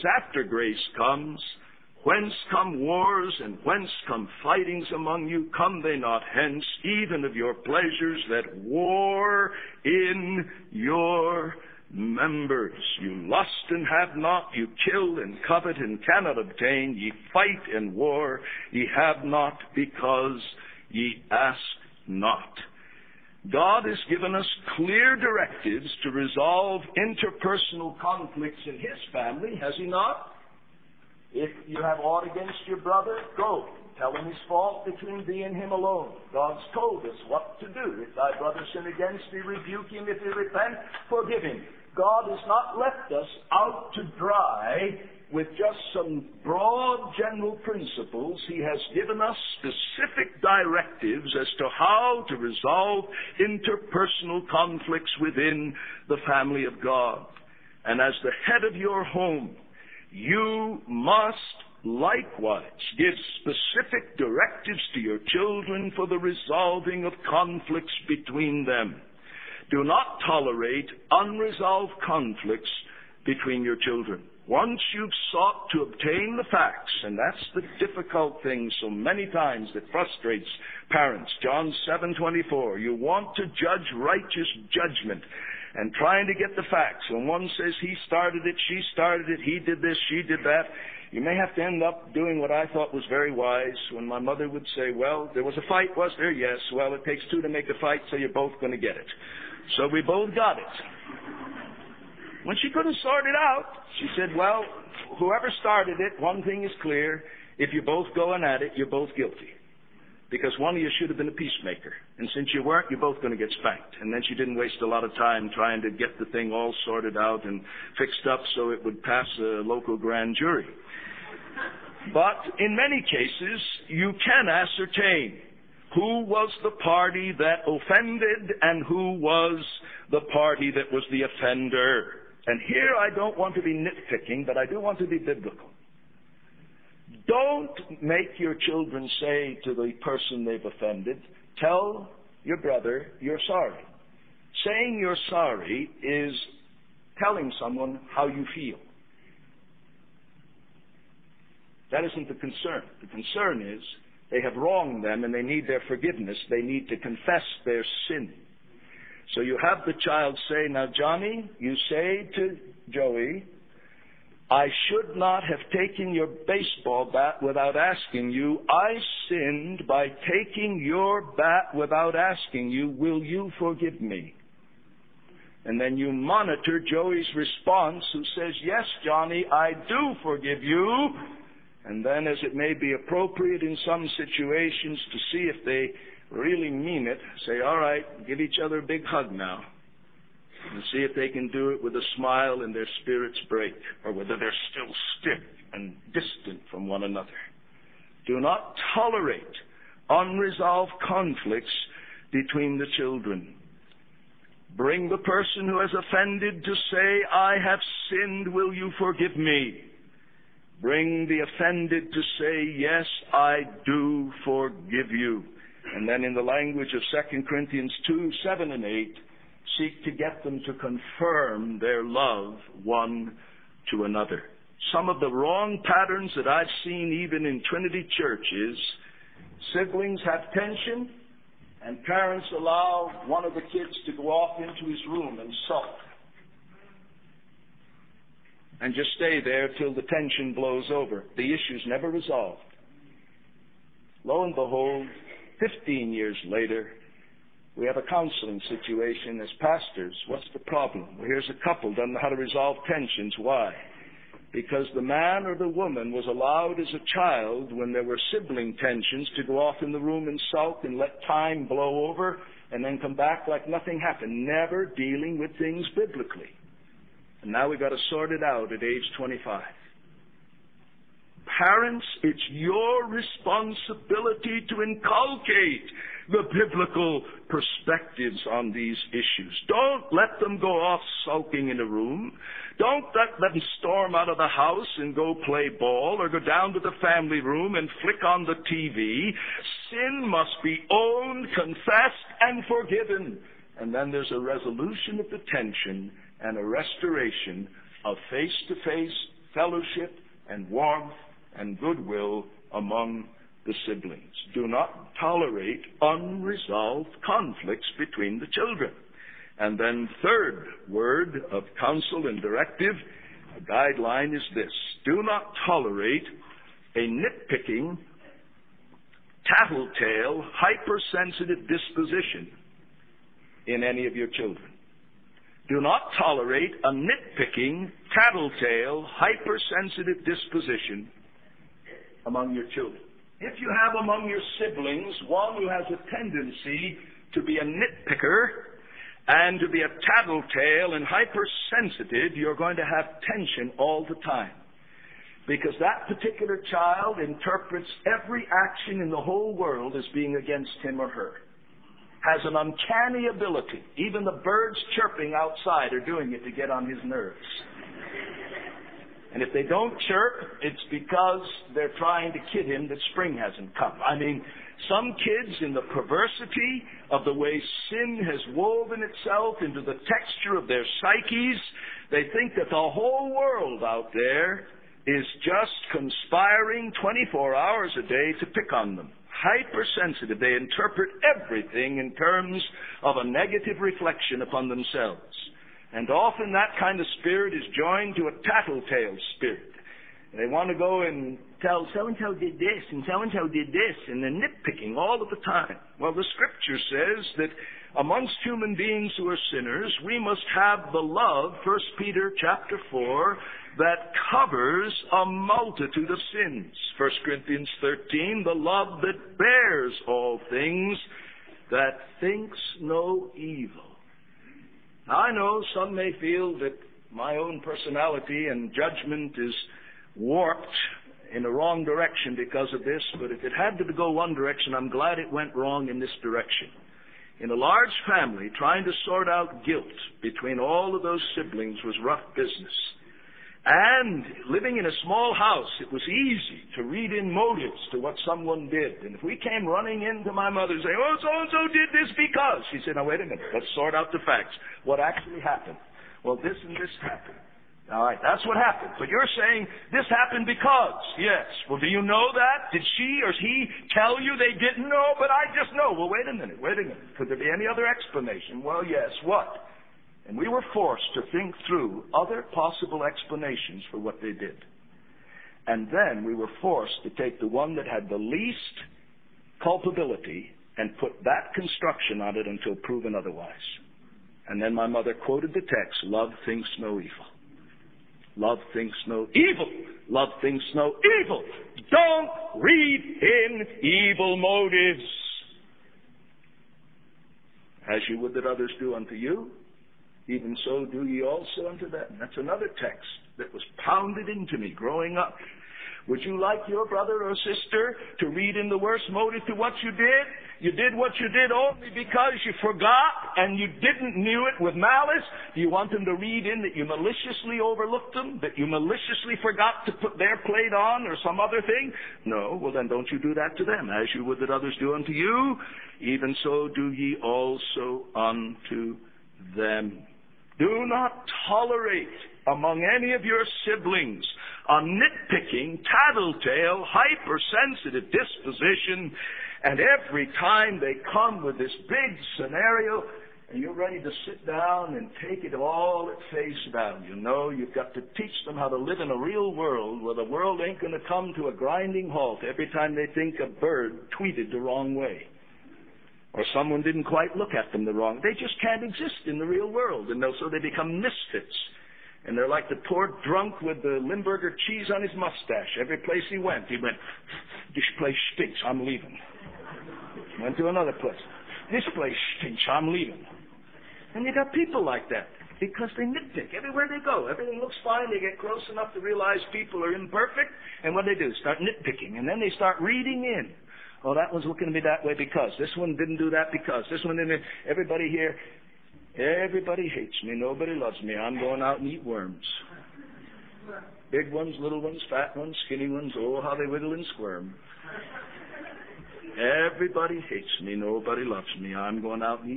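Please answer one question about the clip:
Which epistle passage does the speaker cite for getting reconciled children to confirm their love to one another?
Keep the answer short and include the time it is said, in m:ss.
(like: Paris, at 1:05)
2 Corinthians 2:7-8, at 3:37.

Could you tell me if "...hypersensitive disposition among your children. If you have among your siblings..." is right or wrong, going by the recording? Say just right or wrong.
right.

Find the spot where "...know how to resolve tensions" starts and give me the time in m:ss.
4:12.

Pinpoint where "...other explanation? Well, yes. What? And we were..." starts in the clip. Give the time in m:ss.
7:37.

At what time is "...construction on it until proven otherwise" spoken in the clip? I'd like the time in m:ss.
7:51.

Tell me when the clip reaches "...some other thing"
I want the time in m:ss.
8:31.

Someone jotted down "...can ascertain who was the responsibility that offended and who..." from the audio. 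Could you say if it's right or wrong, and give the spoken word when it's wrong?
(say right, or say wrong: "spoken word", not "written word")
wrong: "party", not "responsibility".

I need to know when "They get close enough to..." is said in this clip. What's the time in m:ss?
9:28.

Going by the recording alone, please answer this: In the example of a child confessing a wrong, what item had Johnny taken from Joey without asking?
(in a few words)
baseball bat.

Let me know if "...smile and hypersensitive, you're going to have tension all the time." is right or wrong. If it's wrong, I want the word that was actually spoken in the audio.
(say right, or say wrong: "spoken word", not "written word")
wrong: "tattletale", not "smile".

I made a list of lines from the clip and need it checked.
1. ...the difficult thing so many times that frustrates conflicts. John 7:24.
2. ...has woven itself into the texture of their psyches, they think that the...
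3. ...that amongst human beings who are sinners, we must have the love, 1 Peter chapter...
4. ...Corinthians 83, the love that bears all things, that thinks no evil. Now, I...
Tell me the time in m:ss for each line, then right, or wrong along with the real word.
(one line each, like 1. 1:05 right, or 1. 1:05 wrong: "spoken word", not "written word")
1. 1:17 wrong: "parents", not "conflicts"
2. 6:08 right
3. 6:37 right
4. 6:47 wrong: "13", not "83".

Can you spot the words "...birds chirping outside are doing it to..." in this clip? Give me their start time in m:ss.
5:54.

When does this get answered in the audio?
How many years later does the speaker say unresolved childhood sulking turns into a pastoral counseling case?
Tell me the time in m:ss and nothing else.
4:05.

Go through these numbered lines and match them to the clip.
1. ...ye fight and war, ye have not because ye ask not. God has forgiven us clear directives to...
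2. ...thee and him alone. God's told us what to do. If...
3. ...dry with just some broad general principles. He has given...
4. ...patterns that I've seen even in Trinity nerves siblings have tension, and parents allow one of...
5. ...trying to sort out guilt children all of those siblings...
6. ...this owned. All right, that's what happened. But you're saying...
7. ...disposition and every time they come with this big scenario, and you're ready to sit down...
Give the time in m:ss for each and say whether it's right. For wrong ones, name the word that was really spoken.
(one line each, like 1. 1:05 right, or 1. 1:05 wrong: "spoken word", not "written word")
1. 0:16 wrong: "given", not "forgiven"
2. 0:35 right
3. 0:44 right
4. 3:45 wrong: "churches", not "nerves"
5. 7:08 wrong: "between", not "children"
6. 7:26 wrong: "happened", not "owned"
7. 8:48 right.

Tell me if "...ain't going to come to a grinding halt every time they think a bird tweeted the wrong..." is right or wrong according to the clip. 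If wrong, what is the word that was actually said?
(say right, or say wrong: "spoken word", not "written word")
right.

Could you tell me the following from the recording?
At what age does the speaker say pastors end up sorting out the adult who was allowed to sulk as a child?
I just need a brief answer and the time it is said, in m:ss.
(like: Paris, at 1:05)
25, at 4:29.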